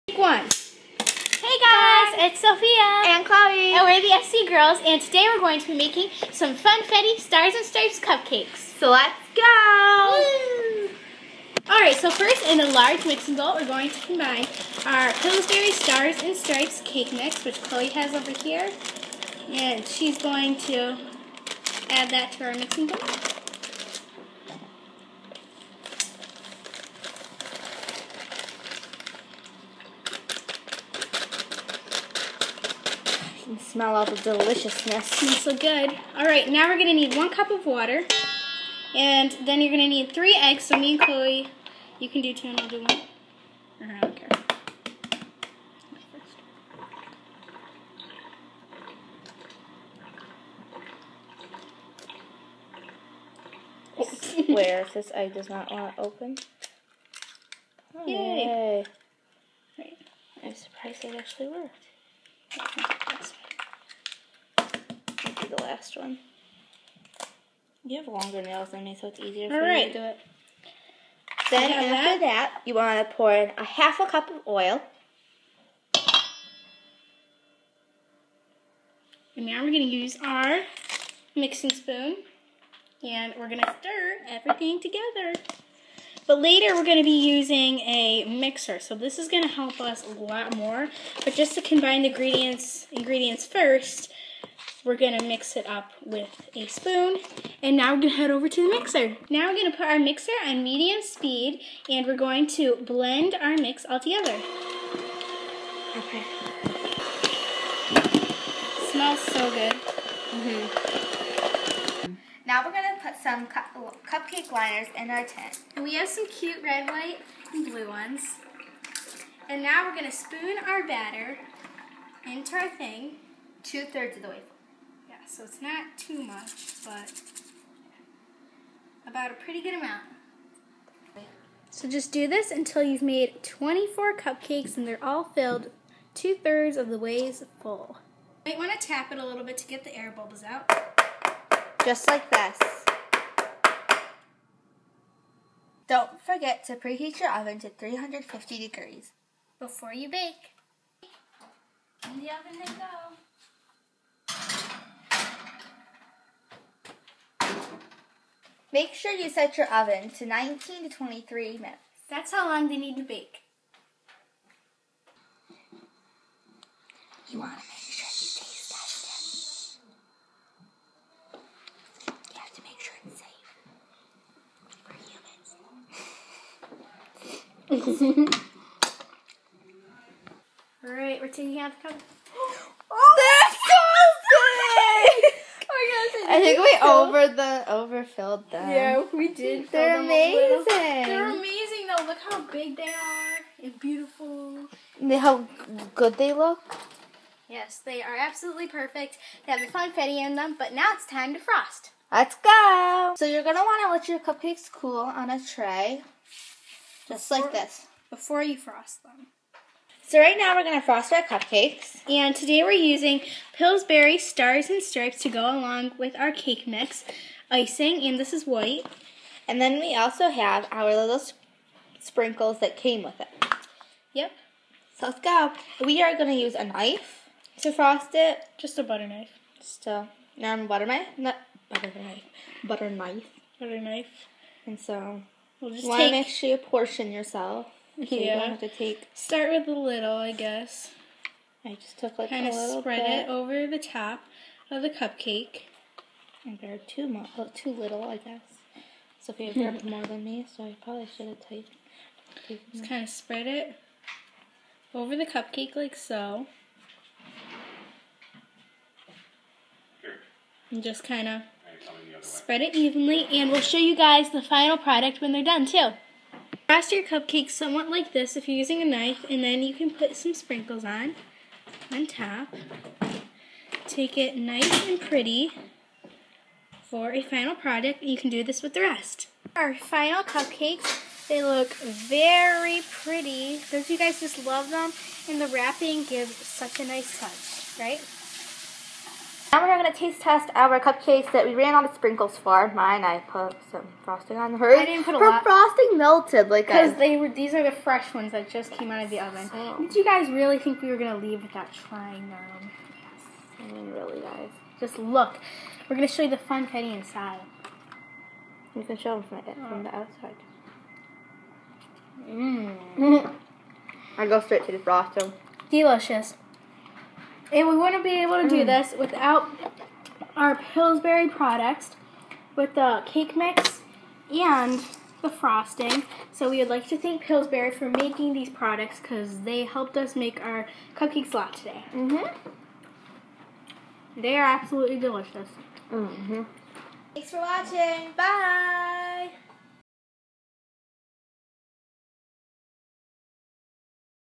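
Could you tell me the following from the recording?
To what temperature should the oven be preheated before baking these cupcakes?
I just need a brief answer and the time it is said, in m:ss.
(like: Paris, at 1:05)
350 degrees, at 2:27.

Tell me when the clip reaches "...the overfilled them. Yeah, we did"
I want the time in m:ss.
3:07.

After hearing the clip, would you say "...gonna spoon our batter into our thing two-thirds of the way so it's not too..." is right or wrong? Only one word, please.
right.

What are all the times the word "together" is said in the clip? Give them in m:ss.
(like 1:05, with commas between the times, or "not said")
1:24, 1:43.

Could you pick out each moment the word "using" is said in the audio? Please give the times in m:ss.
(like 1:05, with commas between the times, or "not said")
1:27, 3:32, 4:28.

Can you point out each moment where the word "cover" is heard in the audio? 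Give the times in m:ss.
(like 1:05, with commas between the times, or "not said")
3:01.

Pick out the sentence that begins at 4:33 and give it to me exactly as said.
Take it nice and pretty for a final product.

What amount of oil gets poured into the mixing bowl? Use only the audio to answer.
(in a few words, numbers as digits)
half a cup.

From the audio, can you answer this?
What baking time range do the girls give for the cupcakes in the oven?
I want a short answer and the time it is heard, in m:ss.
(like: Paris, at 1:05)
19 to 23 minutes, at 2:40.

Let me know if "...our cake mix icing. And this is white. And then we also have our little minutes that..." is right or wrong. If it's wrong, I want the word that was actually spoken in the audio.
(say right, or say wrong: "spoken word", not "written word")
wrong: "sprinkles", not "minutes".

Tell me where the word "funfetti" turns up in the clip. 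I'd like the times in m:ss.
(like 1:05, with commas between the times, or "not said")
0:06, 3:19, 5:06.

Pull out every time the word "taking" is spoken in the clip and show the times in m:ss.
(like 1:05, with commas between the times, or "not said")
3:01.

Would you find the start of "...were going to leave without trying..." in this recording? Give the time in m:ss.
5:00.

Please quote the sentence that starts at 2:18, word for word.
You might want to tap it a little bit to get the air bubbles out.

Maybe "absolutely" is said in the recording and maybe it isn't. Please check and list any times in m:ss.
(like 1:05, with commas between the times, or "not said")
3:18, 5:34.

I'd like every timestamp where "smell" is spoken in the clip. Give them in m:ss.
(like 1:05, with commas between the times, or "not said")
0:33, 1:48.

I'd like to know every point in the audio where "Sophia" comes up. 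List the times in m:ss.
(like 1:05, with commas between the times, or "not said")
0:02.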